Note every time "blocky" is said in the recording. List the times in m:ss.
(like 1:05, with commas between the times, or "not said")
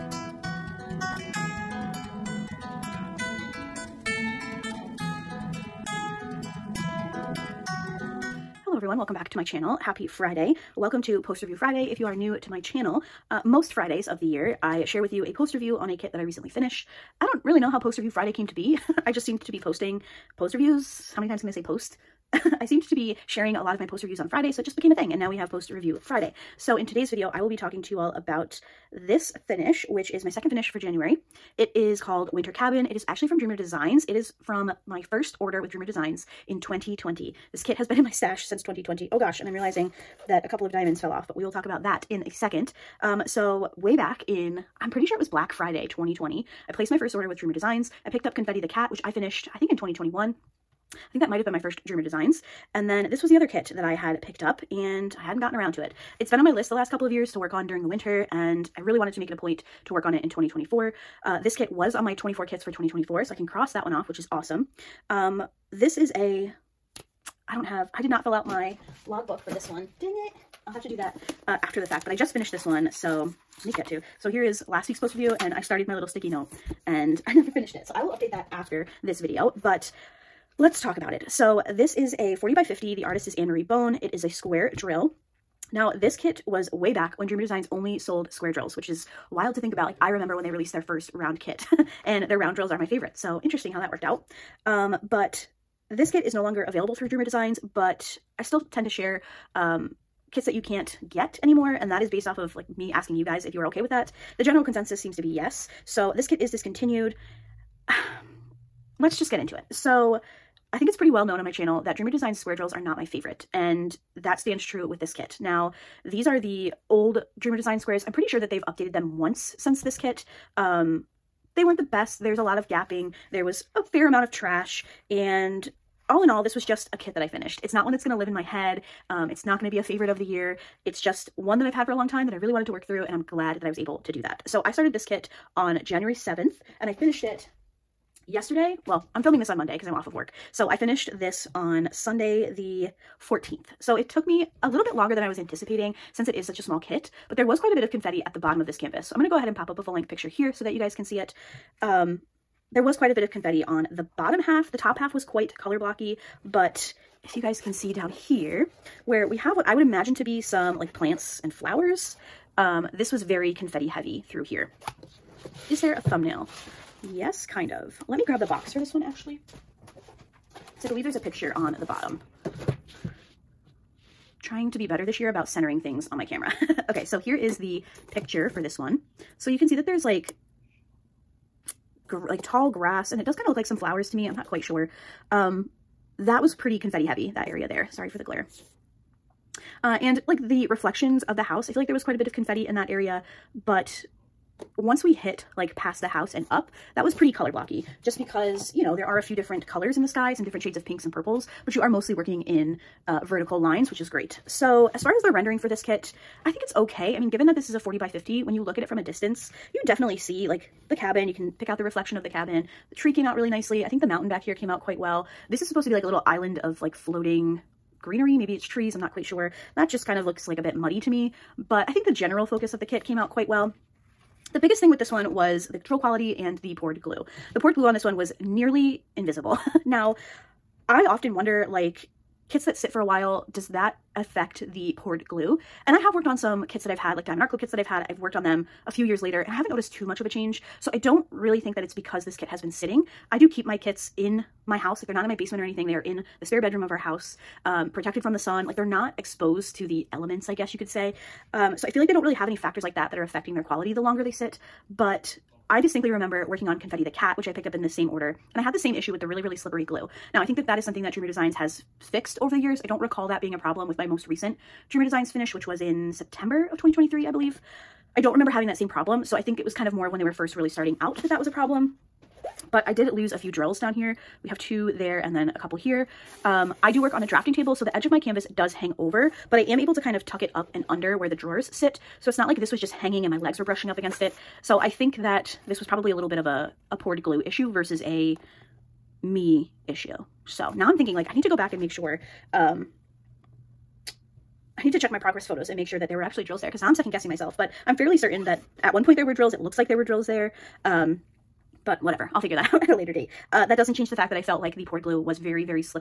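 2:35, 3:17.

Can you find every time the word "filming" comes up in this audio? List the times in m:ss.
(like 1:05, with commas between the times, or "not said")
2:19.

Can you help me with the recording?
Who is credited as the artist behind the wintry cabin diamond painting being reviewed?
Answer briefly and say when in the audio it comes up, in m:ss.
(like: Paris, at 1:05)
Anne-Marie Bone, at 1:23.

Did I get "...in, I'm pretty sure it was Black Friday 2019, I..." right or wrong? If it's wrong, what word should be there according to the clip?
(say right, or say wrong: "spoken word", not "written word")
wrong: "2020", not "2019".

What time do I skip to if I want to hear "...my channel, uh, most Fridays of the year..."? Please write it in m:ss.
0:12.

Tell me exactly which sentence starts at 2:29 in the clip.
So I'm gonna go ahead and pop up a full length picture here so that you guys can see it.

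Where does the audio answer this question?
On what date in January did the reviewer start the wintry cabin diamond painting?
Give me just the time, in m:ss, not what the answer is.
2:15.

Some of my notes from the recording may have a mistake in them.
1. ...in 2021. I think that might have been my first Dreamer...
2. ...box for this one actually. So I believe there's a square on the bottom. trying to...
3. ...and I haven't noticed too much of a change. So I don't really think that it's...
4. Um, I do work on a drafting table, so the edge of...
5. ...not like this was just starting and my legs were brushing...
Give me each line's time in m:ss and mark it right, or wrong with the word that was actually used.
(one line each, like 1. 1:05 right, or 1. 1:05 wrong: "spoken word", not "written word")
1. 0:49 right
2. 2:48 wrong: "picture", not "square"
3. 3:59 right
4. 4:36 right
5. 4:42 wrong: "hanging", not "starting".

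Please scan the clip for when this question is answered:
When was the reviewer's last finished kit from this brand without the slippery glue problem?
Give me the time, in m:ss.
4:26.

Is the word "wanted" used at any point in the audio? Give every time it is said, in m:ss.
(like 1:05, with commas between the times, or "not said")
0:58, 2:12.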